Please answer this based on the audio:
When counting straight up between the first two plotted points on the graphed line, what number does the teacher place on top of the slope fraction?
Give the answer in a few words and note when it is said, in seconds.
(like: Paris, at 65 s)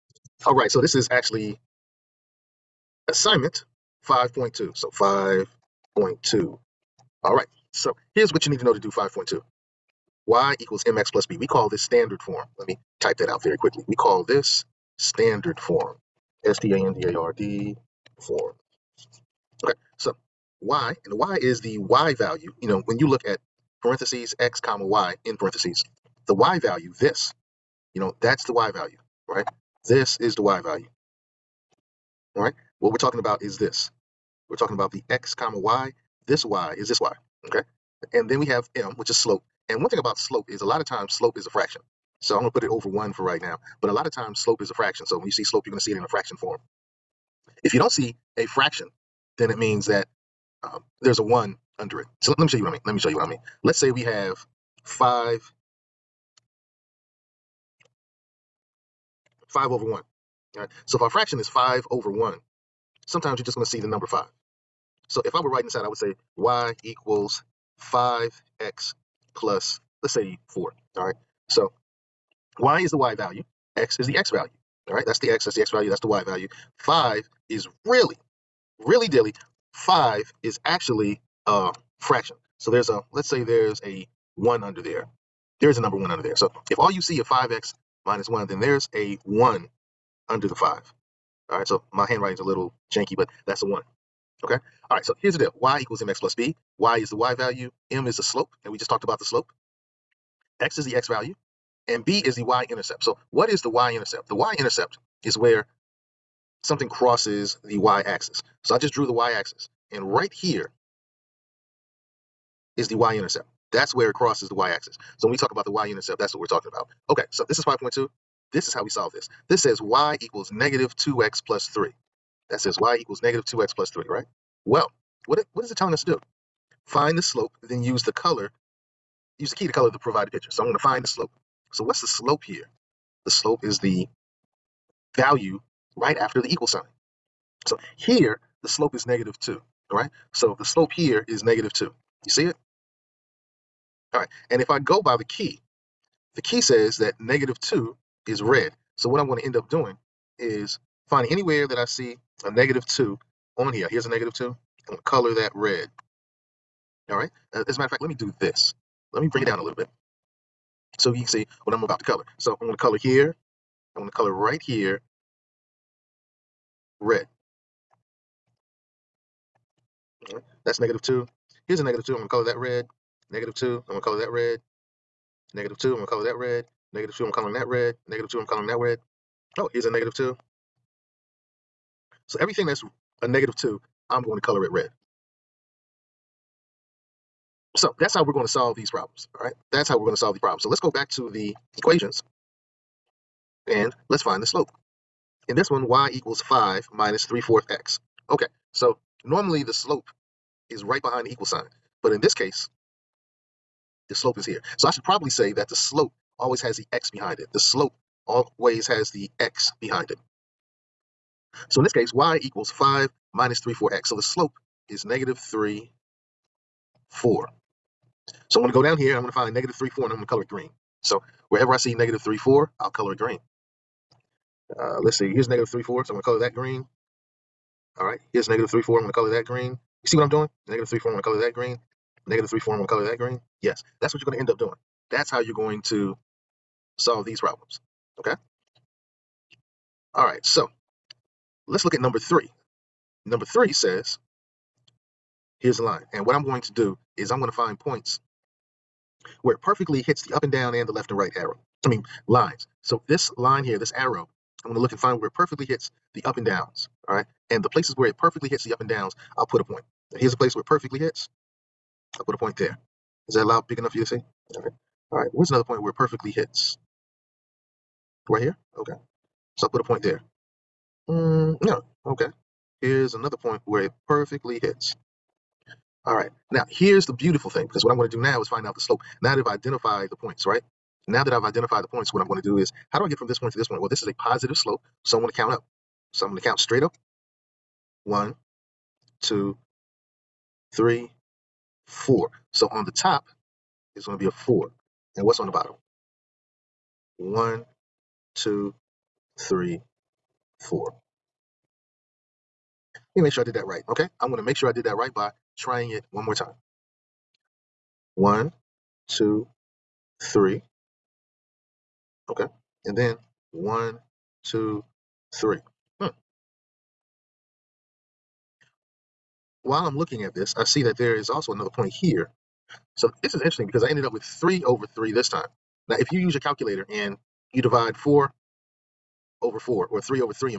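4, at 292 s.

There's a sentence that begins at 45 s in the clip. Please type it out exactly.
So when you see slope, you're going to see it in a fraction form.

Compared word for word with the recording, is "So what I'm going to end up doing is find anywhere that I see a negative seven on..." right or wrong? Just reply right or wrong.
wrong.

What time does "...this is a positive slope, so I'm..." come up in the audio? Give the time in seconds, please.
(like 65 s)
283 s.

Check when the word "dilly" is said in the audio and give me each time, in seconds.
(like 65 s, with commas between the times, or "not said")
79 s.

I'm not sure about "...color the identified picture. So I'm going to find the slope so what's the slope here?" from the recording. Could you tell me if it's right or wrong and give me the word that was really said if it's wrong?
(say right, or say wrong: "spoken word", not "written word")
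wrong: "provided", not "identified".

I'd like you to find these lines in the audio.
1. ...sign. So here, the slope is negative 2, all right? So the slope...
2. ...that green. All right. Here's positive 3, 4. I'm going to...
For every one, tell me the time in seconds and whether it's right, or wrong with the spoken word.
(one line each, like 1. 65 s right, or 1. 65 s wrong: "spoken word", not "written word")
1. 136 s right
2. 226 s wrong: "negative", not "positive".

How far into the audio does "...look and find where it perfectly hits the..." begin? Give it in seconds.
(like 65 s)
254 s.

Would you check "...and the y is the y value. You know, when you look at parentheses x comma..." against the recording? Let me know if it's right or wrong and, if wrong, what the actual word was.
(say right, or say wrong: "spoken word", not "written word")
right.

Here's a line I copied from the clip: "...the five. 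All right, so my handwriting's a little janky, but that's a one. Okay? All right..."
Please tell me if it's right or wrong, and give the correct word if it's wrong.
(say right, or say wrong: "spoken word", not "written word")
right.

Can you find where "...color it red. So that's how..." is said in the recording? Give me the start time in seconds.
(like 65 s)
184 s.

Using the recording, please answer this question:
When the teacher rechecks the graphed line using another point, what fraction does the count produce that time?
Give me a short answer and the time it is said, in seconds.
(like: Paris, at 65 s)
3 over 3, at 324 s.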